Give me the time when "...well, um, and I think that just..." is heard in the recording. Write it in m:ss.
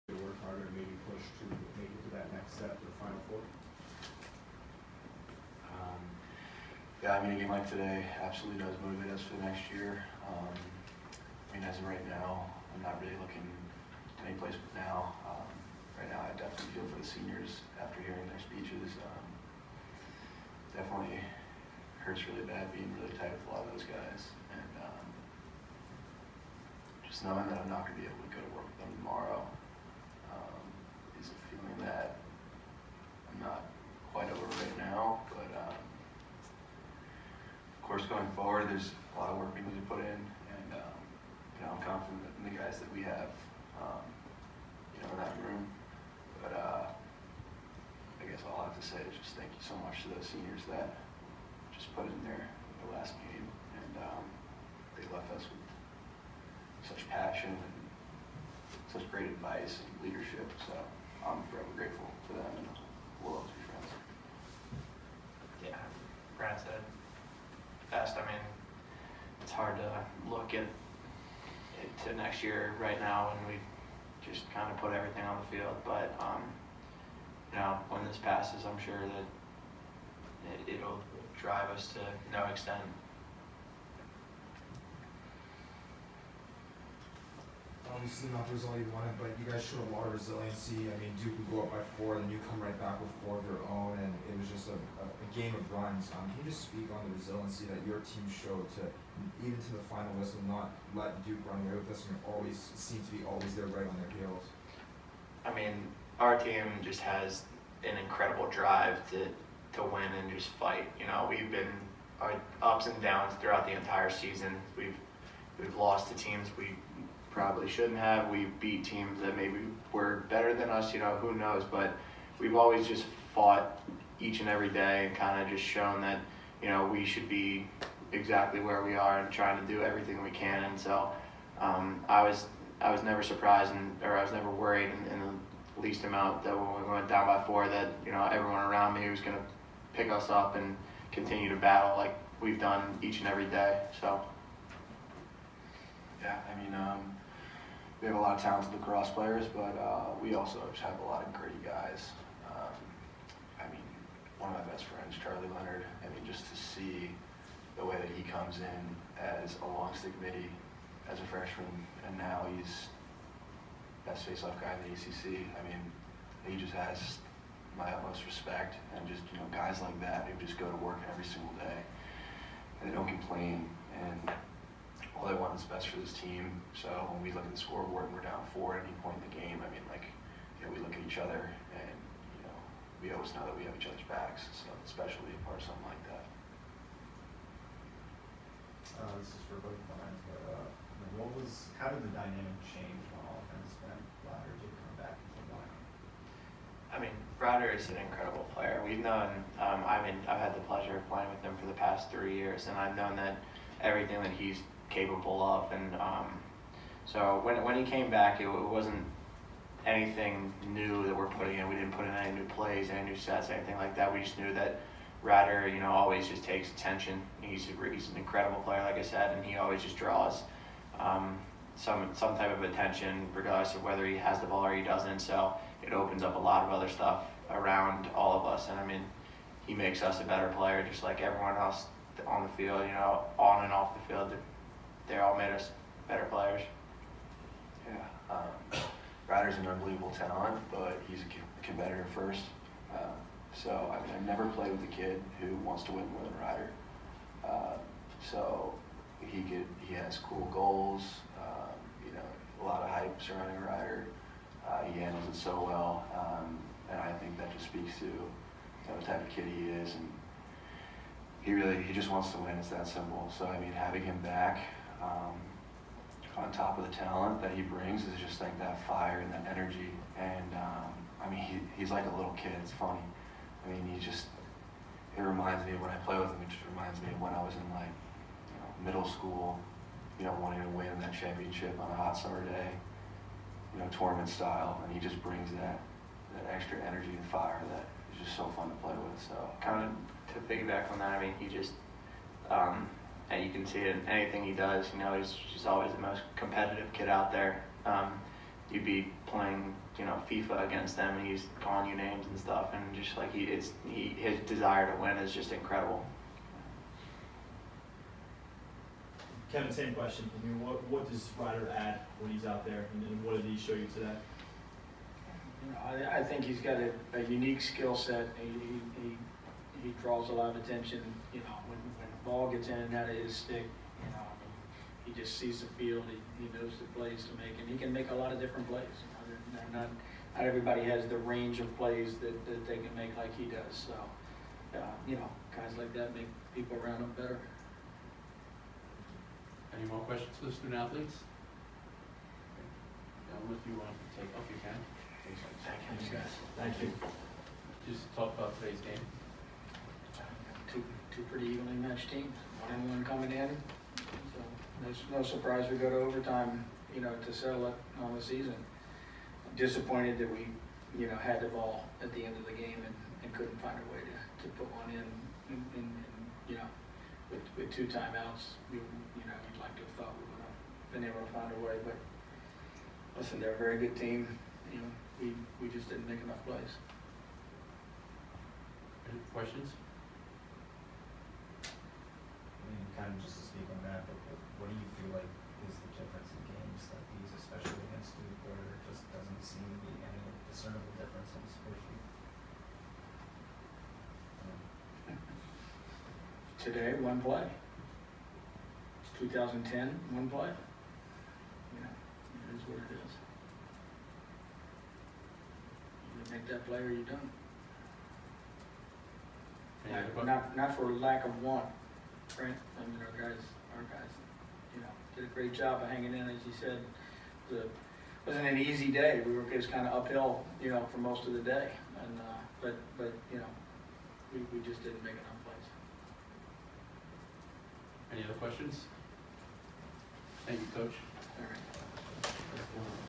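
4:15.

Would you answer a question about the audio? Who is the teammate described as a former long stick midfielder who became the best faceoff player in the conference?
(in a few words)
Charlie Leonard.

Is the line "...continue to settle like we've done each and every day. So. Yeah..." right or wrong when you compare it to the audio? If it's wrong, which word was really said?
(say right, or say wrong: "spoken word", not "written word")
wrong: "battle", not "settle".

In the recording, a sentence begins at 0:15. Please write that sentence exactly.
Um, right now, I definitely feel for the seniors after hearing their speeches.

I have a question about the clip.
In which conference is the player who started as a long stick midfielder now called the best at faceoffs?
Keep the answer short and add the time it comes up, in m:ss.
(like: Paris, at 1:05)
ACC, at 2:44.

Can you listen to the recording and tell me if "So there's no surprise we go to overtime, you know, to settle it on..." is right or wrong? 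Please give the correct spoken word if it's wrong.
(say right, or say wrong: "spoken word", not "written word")
right.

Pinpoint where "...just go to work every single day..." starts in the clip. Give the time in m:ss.
2:50.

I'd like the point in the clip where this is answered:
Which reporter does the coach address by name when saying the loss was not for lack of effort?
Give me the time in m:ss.
6:52.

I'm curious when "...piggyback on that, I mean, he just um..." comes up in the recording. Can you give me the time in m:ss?
4:50.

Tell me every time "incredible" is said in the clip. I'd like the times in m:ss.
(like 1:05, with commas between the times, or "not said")
1:47, 3:17, 3:38, 5:05.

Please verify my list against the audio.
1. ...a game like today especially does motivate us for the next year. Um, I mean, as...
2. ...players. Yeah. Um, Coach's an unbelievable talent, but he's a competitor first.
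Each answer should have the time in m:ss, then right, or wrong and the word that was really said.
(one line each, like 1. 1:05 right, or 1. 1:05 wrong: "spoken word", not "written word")
1. 0:07 wrong: "absolutely", not "especially"
2. 3:56 wrong: "Ryder", not "Coach".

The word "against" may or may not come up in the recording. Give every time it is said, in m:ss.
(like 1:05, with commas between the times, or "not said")
5:00, 6:27.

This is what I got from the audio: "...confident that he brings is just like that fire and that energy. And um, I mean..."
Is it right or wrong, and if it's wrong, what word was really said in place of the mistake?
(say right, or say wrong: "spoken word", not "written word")
wrong: "talent", not "confident".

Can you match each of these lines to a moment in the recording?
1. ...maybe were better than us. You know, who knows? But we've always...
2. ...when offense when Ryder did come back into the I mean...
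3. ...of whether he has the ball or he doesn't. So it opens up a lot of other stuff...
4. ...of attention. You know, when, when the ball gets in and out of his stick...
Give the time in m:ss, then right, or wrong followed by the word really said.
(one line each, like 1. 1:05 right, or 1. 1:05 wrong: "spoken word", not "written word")
1. 1:59 right
2. 3:13 right
3. 3:43 right
4. 5:20 right.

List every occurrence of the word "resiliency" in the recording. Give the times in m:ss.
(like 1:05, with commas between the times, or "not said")
1:30, 1:37.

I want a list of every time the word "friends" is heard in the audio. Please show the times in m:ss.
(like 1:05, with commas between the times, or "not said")
1:03, 2:34.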